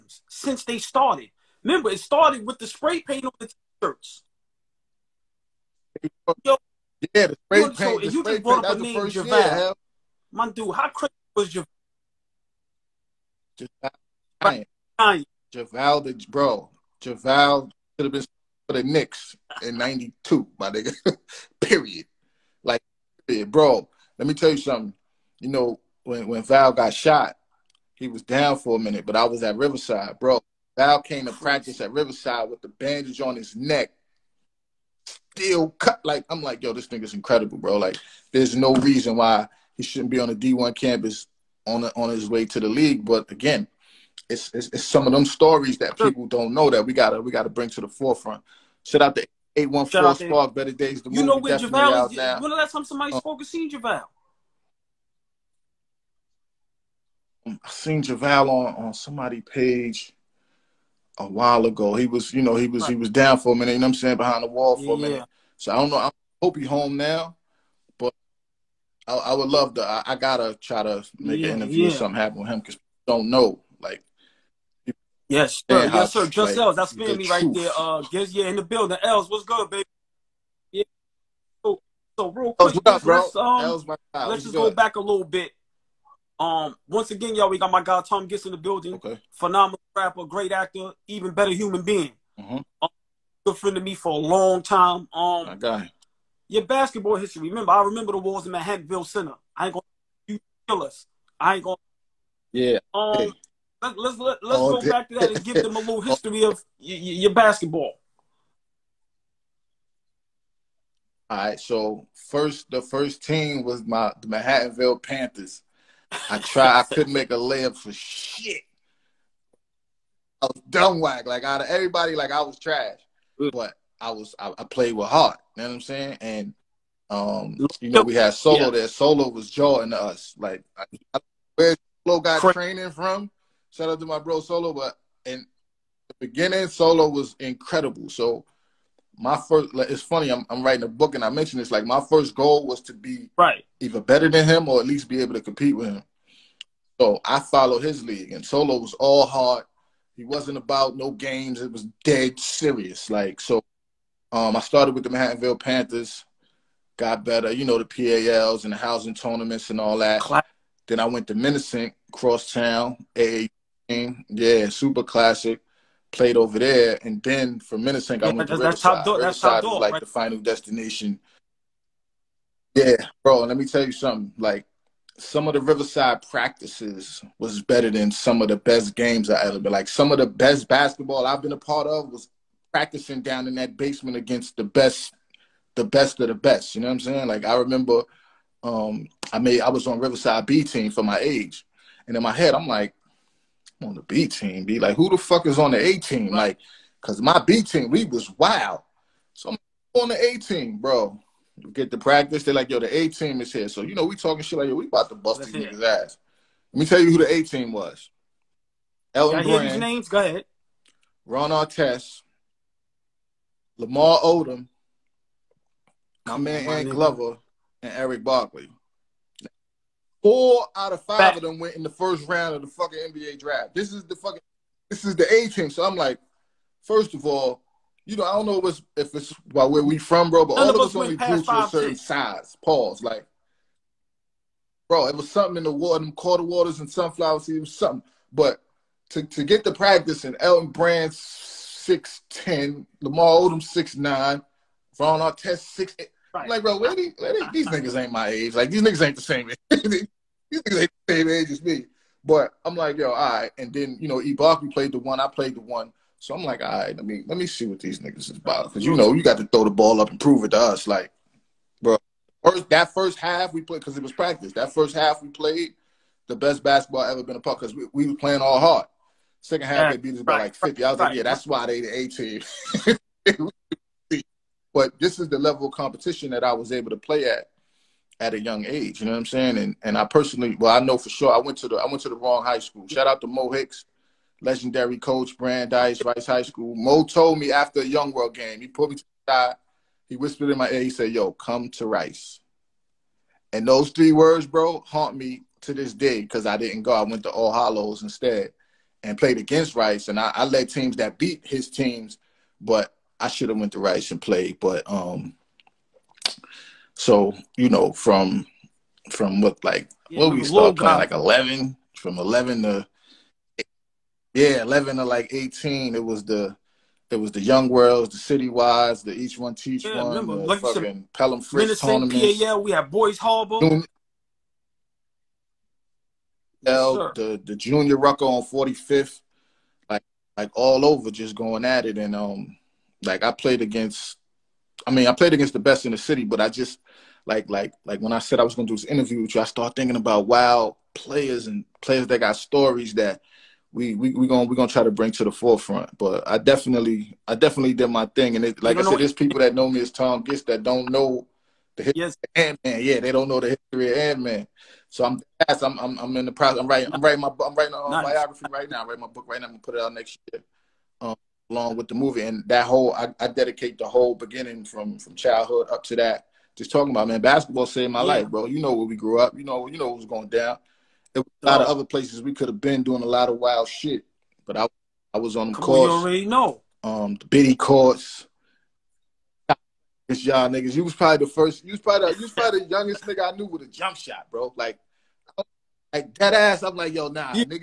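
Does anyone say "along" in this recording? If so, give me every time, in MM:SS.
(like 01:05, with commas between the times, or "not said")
06:01.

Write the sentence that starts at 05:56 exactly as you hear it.
I'm writing I'm writing my I'm writing a nice.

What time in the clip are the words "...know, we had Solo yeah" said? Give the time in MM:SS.
02:07.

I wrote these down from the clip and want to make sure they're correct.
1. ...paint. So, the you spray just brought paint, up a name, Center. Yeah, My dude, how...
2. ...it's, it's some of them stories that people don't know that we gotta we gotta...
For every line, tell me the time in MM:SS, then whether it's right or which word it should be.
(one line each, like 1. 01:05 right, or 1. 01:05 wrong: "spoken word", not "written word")
1. 00:07 wrong: "Javon", not "Center"
2. 00:44 right.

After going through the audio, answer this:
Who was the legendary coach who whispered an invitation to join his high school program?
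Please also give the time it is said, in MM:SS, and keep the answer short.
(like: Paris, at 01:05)
Mo Hicks, at 04:43.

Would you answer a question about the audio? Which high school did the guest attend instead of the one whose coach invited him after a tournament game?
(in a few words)
All Hallows.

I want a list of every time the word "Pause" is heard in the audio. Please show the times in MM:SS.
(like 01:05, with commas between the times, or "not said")
03:52.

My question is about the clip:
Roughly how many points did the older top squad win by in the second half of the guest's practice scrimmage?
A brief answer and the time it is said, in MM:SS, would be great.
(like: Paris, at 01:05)
50, at 04:30.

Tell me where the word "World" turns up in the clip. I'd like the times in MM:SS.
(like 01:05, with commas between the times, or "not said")
04:48, 05:17.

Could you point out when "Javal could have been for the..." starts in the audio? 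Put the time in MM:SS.
00:17.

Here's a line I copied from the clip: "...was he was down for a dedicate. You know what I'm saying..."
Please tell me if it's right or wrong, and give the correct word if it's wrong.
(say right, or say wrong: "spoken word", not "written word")
wrong: "minute", not "dedicate".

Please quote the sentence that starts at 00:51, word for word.
The you movie know where Javale is?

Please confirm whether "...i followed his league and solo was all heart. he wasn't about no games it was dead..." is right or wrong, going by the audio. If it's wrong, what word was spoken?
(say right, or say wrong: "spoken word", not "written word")
right.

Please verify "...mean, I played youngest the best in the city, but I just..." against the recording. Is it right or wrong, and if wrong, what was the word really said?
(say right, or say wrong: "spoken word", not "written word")
wrong: "against", not "youngest".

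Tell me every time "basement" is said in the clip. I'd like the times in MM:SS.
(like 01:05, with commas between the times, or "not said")
03:03.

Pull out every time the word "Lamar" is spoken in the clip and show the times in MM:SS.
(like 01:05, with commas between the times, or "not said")
03:33, 04:03.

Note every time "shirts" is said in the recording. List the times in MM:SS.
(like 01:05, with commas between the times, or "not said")
00:03.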